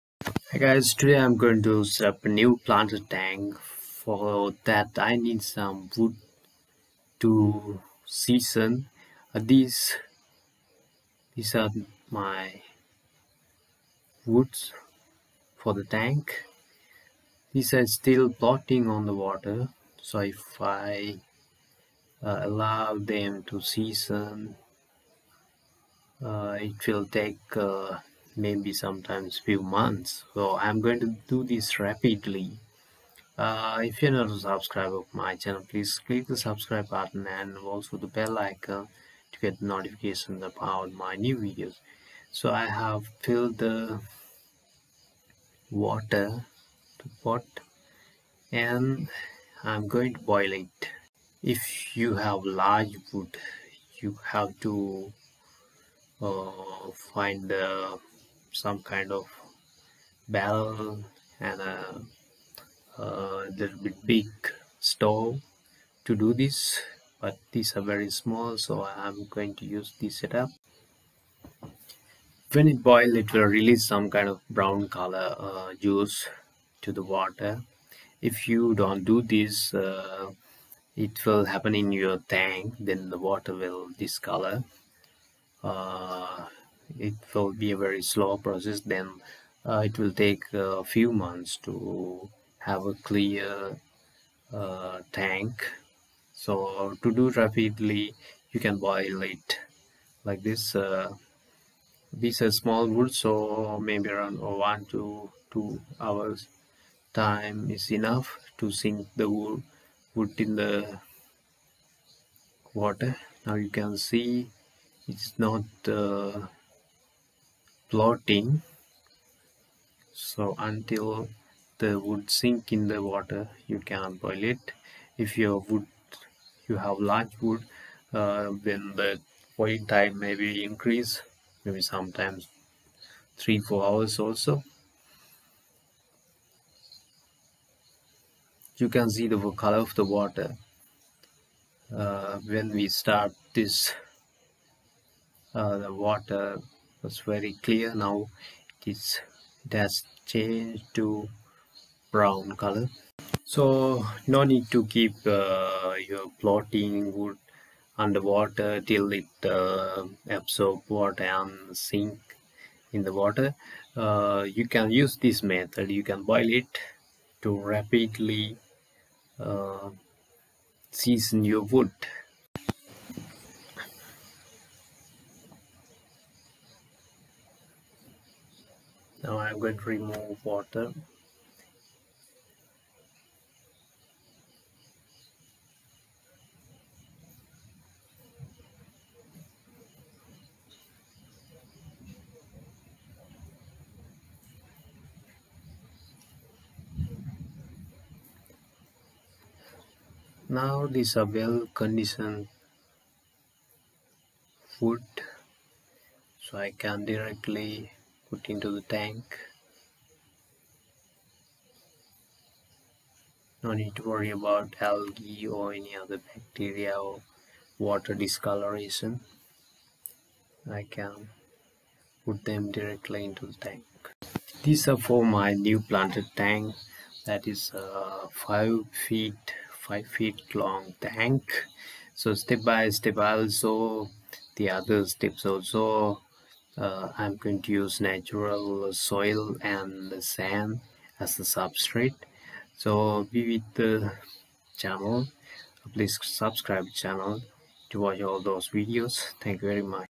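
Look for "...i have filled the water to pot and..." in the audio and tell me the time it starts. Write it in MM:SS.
00:42.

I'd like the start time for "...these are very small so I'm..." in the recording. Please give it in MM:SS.
01:07.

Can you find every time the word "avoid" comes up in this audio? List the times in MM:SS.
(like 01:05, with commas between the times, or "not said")
not said.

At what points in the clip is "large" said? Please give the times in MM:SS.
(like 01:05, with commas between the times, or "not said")
00:52, 02:07.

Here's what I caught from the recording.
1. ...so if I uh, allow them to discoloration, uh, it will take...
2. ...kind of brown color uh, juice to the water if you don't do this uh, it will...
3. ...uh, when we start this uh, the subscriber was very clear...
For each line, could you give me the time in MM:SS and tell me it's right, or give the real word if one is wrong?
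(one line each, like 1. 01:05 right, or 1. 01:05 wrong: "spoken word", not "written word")
1. 00:20 wrong: "season", not "discoloration"
2. 01:14 right
3. 02:22 wrong: "water", not "subscriber".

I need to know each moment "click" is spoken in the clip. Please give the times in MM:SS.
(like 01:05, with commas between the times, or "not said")
00:36.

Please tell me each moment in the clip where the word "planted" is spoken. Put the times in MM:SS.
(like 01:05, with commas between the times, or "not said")
00:02, 03:45.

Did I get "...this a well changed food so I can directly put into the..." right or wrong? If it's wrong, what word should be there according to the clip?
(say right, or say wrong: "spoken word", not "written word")
wrong: "conditioned", not "changed".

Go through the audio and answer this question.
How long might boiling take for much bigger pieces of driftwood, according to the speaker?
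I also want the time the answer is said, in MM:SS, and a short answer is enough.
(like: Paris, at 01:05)
3 to 4 hours, at 02:13.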